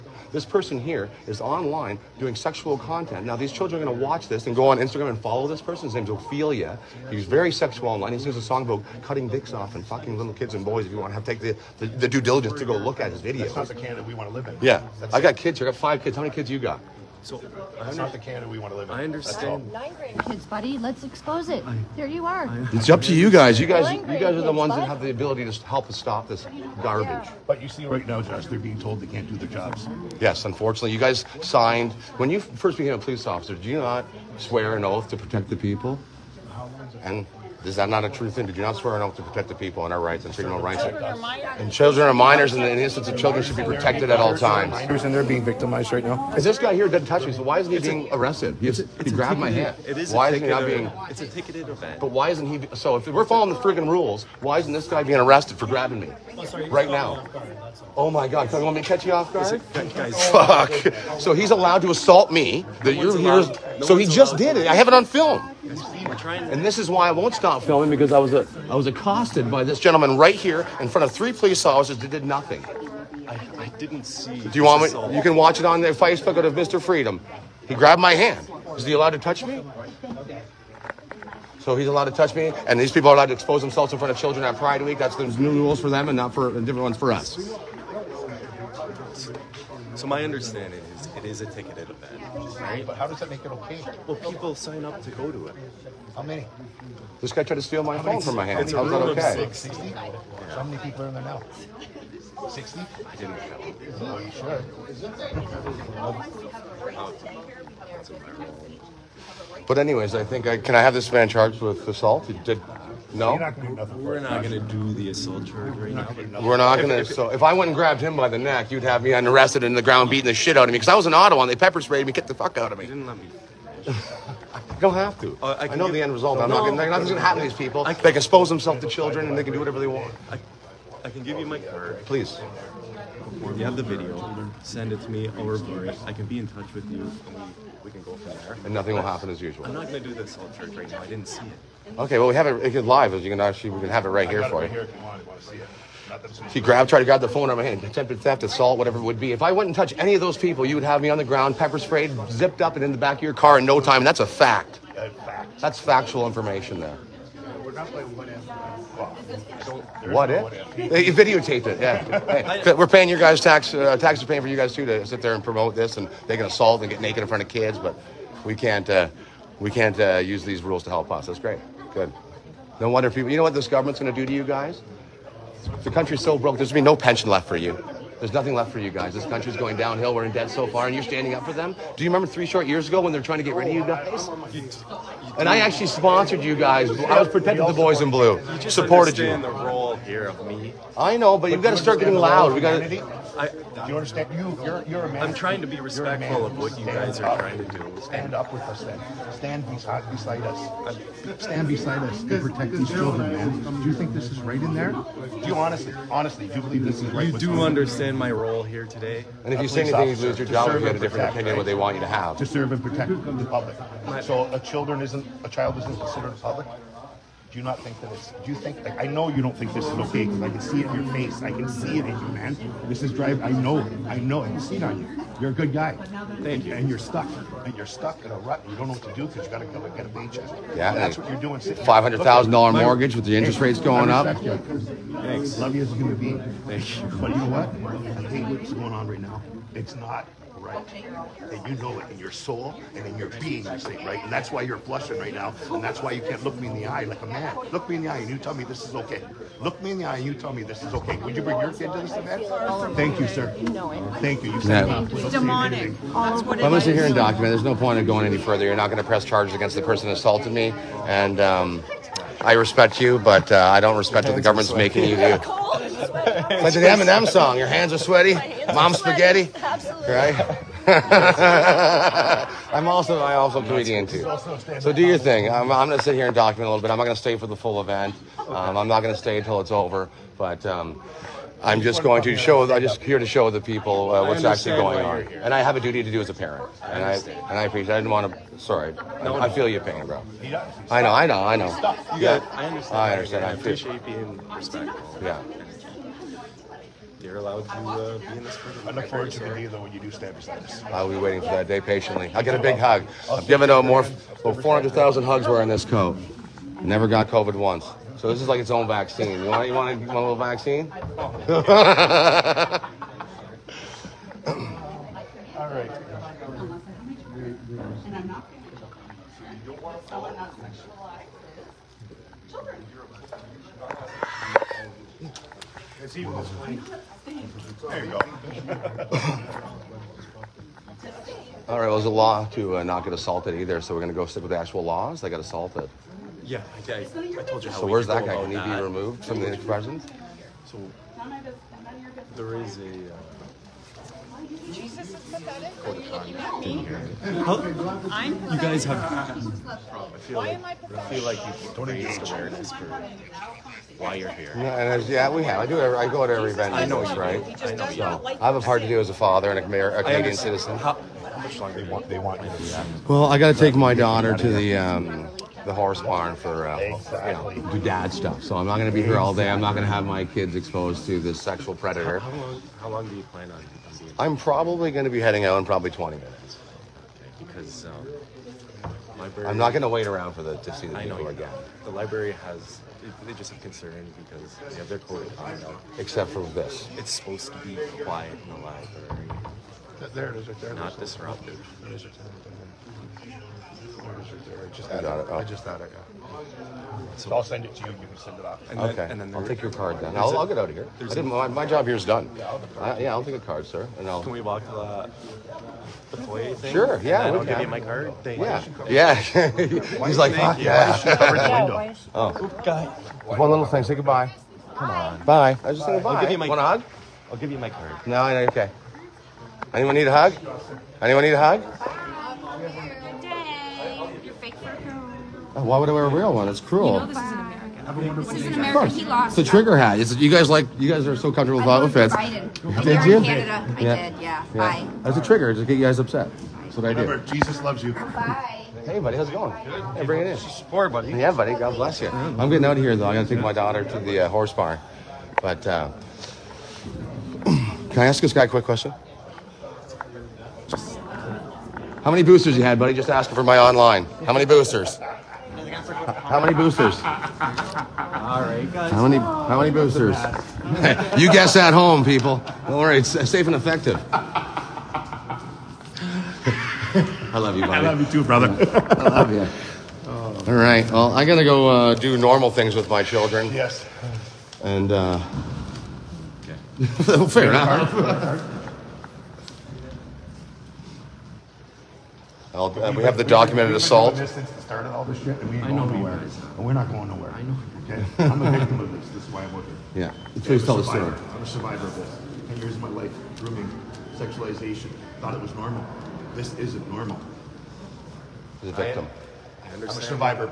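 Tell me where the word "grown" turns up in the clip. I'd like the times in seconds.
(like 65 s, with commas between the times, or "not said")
not said.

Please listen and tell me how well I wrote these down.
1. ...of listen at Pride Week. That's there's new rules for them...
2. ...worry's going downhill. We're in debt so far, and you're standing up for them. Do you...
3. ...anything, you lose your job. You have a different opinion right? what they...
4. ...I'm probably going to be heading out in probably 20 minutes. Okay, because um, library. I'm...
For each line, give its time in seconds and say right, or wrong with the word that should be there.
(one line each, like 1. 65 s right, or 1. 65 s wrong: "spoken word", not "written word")
1. 84 s wrong: "children", not "listen"
2. 179 s wrong: "country", not "worry"
3. 209 s right
4. 374 s right.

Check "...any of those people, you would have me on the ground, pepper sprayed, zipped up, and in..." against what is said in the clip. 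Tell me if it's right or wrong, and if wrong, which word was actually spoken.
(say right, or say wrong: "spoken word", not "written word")
right.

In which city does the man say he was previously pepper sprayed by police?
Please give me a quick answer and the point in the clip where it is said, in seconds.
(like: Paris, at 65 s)
Ottawa, at 121 s.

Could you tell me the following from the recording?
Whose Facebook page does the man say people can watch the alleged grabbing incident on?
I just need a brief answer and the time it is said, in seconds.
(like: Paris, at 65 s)
Mr. Freedom, at 76 s.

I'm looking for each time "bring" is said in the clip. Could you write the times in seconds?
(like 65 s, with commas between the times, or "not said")
251 s, 440 s.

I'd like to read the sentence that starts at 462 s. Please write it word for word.
Don't worry, it's safe and effective.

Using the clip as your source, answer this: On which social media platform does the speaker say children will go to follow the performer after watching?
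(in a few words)
Instagram.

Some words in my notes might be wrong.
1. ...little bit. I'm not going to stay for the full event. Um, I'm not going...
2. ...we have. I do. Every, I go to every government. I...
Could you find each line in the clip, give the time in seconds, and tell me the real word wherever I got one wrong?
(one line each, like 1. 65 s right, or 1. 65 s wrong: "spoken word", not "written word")
1. 276 s right
2. 355 s wrong: "event", not "government".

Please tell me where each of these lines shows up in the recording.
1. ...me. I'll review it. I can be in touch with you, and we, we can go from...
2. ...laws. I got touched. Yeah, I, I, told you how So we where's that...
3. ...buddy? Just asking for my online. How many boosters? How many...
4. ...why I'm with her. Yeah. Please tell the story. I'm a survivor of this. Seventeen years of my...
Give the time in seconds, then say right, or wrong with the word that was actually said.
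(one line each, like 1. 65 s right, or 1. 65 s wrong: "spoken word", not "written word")
1. 135 s right
2. 334 s wrong: "assaulted", not "touched"
3. 452 s right
4. 489 s wrong: "Ten", not "Seventeen".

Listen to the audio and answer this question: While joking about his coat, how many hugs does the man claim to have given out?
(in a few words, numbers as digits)
400,000.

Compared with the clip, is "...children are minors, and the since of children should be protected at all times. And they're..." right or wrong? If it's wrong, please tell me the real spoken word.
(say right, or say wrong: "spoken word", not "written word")
wrong: "innocence", not "since".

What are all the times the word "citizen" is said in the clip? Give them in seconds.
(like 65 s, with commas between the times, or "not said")
360 s.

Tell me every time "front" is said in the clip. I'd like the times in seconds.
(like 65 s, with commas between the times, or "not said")
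70 s, 83 s, 167 s.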